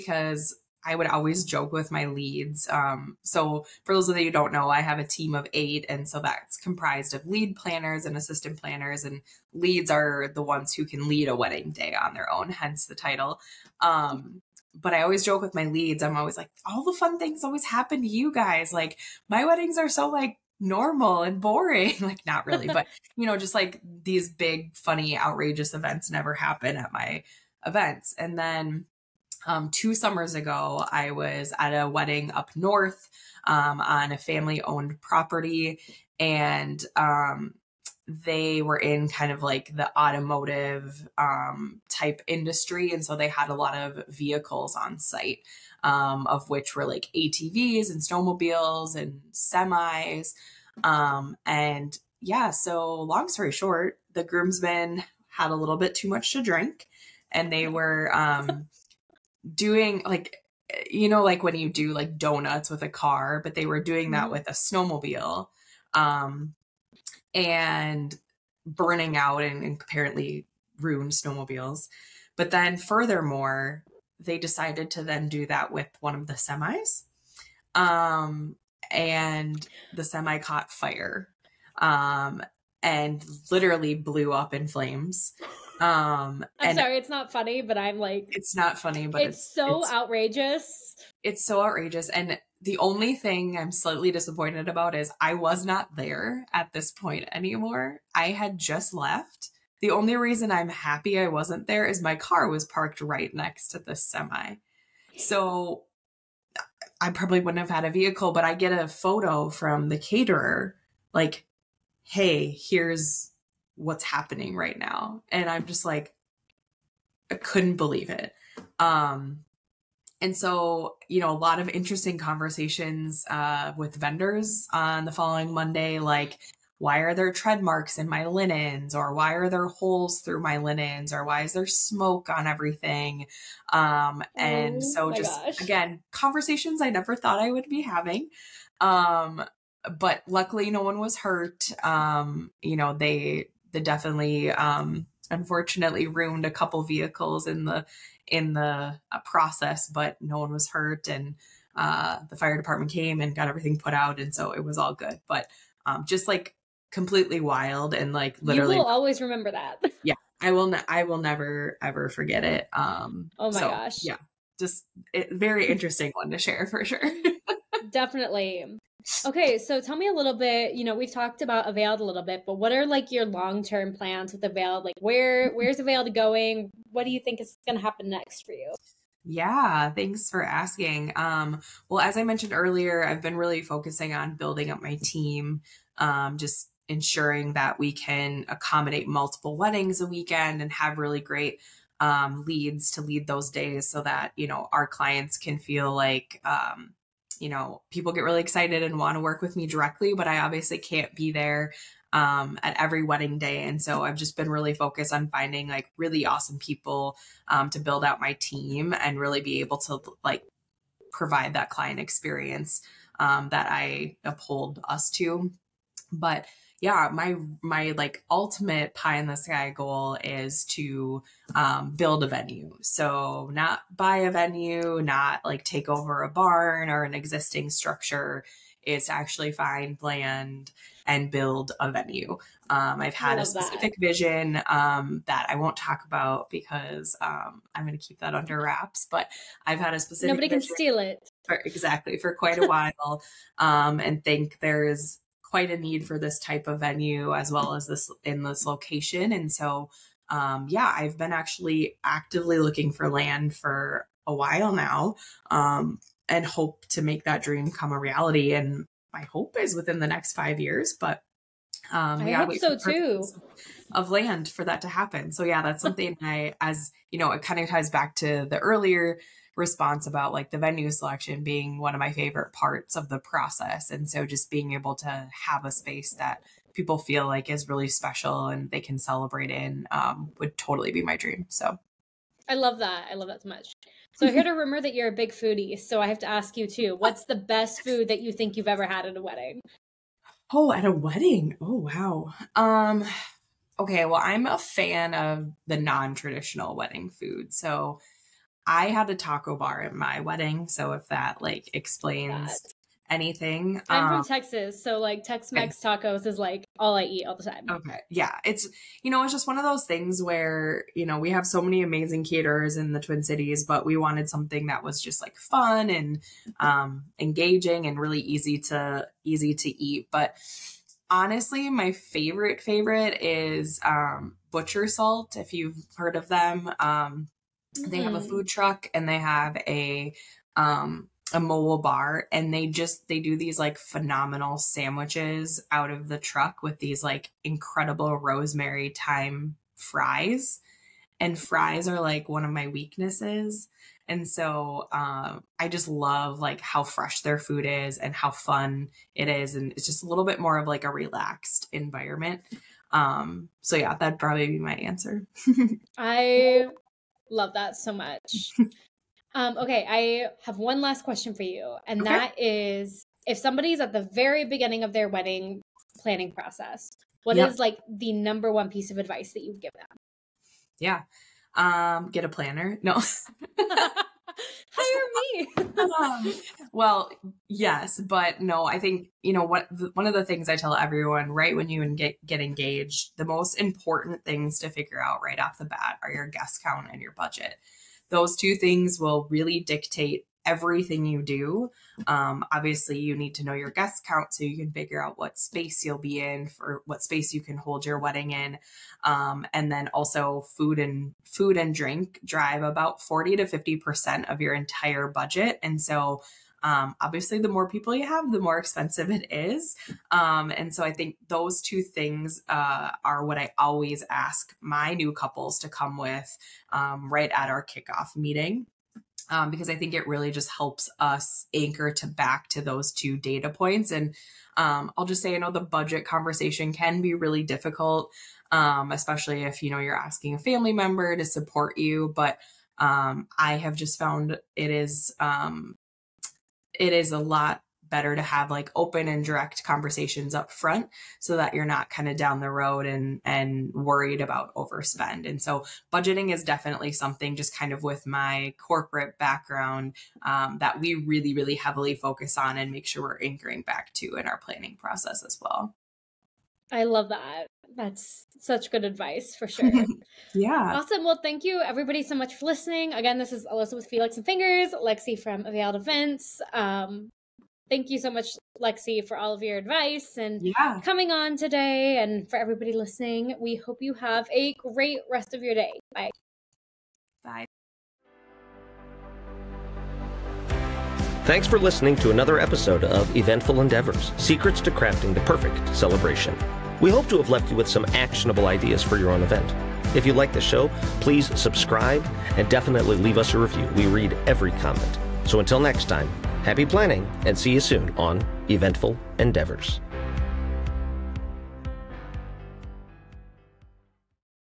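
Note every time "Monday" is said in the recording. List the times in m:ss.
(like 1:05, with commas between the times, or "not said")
2:05.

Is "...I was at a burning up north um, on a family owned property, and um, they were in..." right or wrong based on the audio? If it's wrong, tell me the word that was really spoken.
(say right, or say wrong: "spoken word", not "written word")
wrong: "wedding", not "burning".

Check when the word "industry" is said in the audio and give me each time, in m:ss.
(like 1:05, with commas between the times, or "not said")
0:42.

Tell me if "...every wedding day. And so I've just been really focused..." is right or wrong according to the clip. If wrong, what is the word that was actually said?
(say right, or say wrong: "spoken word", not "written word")
right.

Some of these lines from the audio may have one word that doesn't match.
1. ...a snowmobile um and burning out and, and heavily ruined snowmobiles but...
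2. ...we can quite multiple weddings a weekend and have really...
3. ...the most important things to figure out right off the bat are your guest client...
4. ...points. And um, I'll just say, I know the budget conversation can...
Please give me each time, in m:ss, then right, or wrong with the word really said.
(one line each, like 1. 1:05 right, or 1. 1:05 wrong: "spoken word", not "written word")
1. 1:04 wrong: "apparently", not "heavily"
2. 3:07 wrong: "accommodate", not "quite"
3. 6:23 wrong: "count", not "client"
4. 7:03 right.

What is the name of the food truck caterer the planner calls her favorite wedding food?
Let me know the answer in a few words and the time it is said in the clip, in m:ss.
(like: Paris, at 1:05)
Butcher Salt, at 5:24.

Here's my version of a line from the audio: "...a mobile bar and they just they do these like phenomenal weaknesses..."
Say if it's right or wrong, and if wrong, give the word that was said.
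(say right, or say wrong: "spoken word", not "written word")
wrong: "sandwiches", not "weaknesses".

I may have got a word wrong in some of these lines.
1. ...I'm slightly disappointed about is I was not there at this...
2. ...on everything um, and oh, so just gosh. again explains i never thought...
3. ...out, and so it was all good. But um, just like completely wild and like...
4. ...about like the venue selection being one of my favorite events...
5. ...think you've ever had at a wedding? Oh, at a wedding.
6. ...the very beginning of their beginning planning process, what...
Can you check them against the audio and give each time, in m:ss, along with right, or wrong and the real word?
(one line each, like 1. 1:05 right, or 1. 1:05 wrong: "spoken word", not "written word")
1. 1:33 right
2. 2:12 wrong: "conversations", not "explains"
3. 2:33 right
4. 4:30 wrong: "parts", not "events"
5. 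4:48 right
6. 6:03 wrong: "wedding", not "beginning".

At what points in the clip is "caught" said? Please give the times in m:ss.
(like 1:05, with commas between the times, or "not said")
1:20.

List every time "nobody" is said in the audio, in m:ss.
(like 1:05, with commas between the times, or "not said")
4:00.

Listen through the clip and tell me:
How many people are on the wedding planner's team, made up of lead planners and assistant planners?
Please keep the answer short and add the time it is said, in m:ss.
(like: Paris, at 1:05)
8, at 0:05.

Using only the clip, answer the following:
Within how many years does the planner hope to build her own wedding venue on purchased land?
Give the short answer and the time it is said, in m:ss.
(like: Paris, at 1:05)
5, at 4:20.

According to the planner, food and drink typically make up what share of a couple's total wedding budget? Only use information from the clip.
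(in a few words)
40 to 50 percent.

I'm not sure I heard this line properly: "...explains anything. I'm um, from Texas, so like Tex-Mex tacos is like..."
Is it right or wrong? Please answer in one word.
right.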